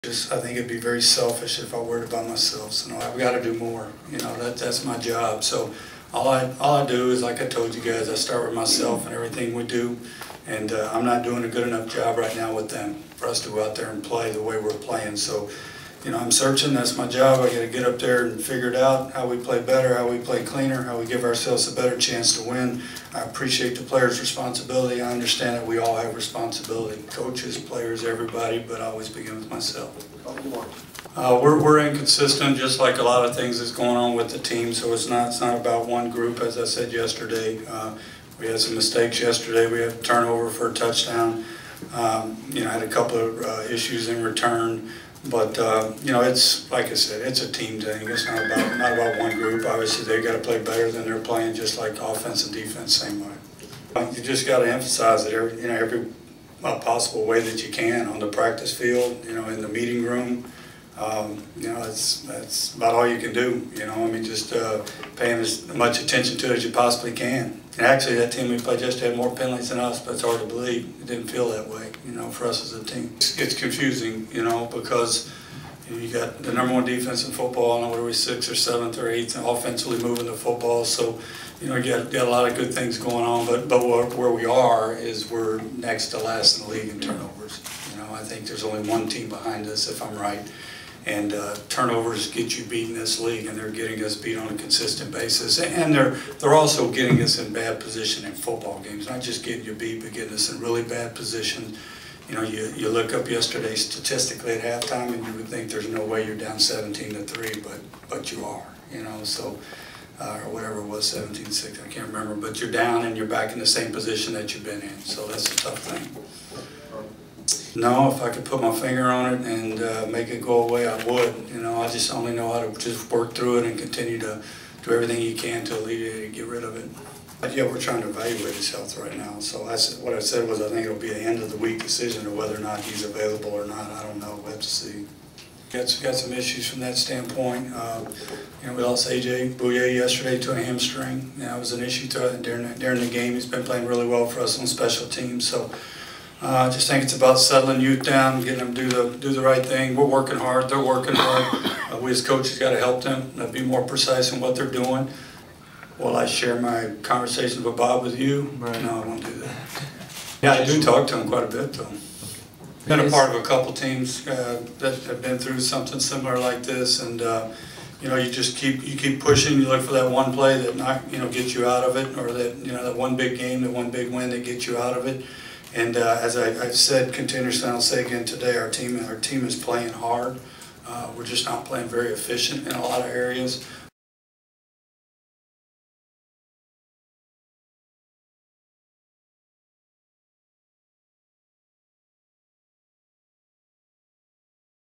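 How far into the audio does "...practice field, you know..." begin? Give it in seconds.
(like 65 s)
58 s.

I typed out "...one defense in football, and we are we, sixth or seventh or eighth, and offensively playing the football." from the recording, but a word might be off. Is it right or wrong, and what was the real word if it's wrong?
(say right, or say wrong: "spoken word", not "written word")
wrong: "moving", not "playing".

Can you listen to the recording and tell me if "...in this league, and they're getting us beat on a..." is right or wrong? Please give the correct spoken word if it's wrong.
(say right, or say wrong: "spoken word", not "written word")
right.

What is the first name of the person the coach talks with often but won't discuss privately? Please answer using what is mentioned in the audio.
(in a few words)
Bob.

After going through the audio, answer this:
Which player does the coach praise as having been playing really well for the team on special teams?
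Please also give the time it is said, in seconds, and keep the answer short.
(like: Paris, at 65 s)
AJ Bouye, at 139 s.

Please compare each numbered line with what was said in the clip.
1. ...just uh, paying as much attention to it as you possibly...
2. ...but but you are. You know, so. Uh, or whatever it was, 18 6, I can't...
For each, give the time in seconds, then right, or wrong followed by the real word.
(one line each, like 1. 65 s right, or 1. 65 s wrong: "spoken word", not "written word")
1. 64 s right
2. 107 s wrong: "17", not "18".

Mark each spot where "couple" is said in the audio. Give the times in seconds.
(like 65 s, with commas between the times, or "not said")
42 s, 163 s.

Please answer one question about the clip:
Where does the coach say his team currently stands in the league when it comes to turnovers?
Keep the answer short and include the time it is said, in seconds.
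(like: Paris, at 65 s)
next to last, at 85 s.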